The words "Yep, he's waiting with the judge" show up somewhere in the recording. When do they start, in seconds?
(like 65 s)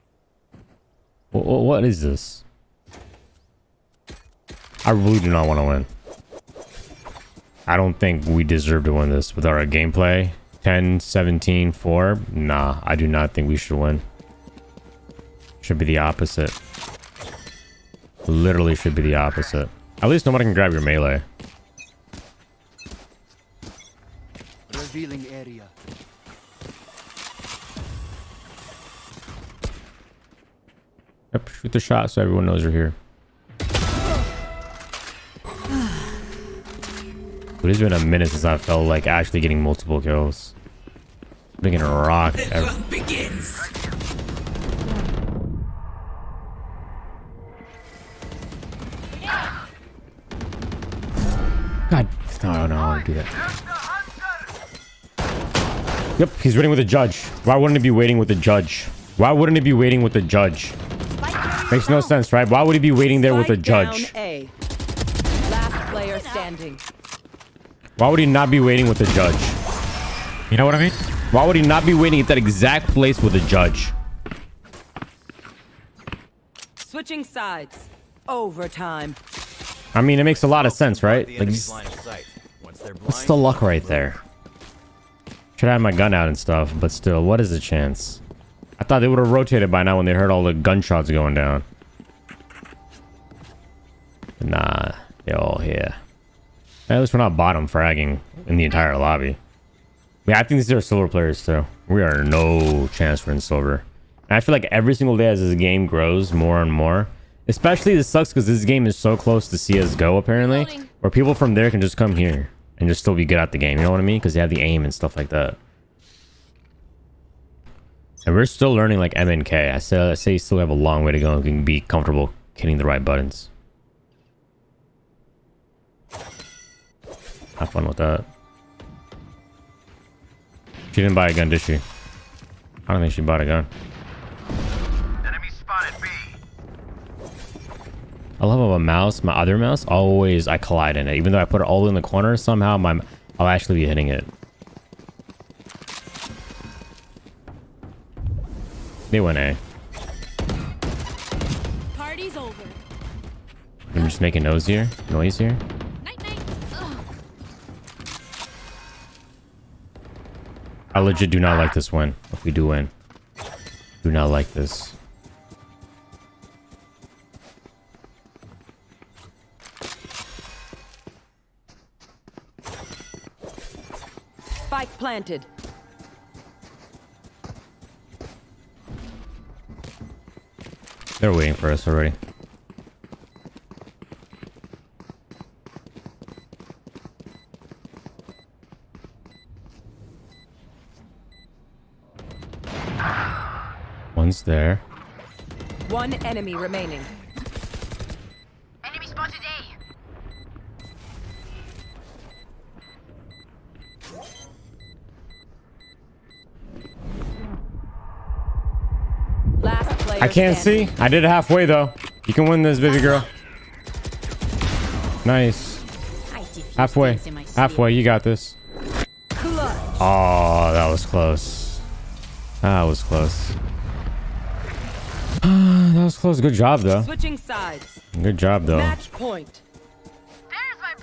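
56 s.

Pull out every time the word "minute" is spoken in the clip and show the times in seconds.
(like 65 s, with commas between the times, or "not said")
38 s.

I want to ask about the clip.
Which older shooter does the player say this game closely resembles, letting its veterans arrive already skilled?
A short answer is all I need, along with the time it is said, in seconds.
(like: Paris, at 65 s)
CSGO, at 109 s.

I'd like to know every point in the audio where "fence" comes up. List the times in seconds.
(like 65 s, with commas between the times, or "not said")
not said.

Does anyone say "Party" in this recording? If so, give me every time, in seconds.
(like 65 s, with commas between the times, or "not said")
151 s.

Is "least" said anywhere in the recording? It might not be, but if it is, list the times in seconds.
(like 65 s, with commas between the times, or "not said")
20 s, 97 s.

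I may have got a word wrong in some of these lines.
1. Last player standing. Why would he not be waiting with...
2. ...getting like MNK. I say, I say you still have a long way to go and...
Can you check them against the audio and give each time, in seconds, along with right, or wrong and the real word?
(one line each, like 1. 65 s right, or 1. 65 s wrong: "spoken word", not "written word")
1. 64 s right
2. 118 s wrong: "learning", not "getting".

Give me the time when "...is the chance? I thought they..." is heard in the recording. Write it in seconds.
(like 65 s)
87 s.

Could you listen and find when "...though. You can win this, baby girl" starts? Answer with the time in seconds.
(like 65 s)
211 s.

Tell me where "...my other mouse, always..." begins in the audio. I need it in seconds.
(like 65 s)
139 s.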